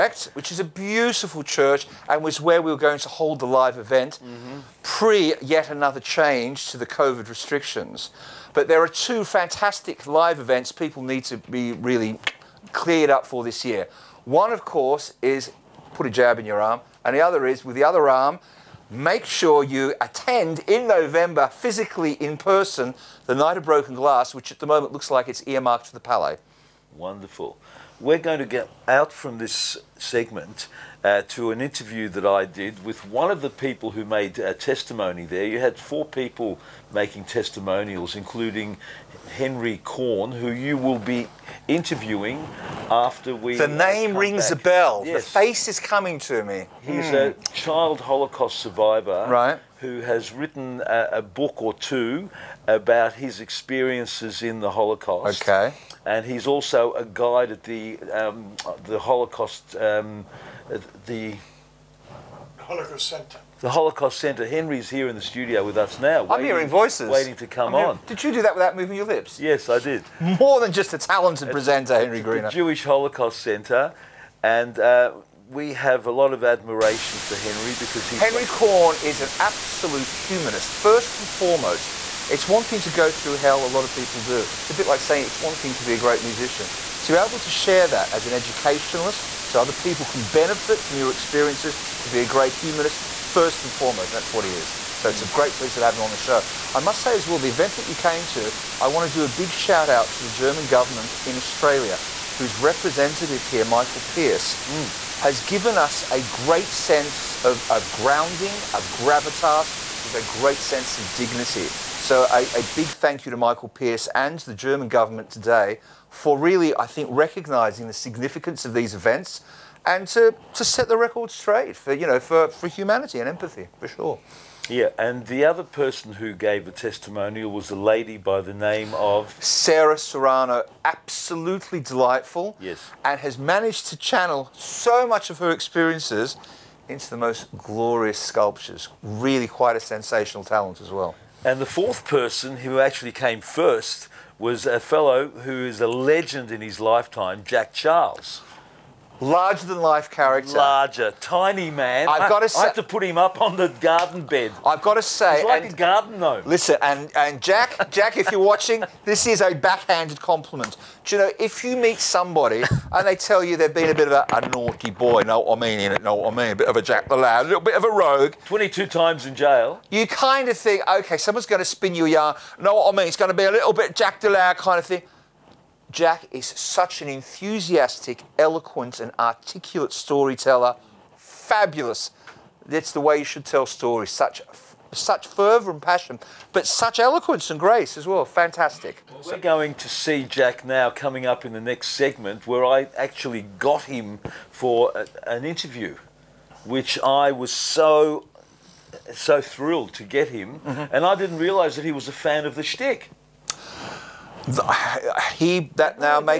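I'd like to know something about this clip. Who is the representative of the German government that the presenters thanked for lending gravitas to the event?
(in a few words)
Michael Pearce.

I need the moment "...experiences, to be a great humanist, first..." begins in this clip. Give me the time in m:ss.
1:31.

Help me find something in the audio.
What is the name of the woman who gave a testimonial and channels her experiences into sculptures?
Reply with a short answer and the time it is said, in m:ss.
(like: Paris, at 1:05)
Sarah Serrano, at 2:09.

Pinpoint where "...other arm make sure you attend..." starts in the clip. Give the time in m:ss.
0:17.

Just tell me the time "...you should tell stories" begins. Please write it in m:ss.
3:03.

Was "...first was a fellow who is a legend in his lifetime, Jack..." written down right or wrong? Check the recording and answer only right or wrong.
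right.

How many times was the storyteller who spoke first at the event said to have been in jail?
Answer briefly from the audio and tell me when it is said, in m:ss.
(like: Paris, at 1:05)
22, at 2:48.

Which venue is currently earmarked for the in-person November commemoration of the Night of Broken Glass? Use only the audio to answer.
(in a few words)
The Palais.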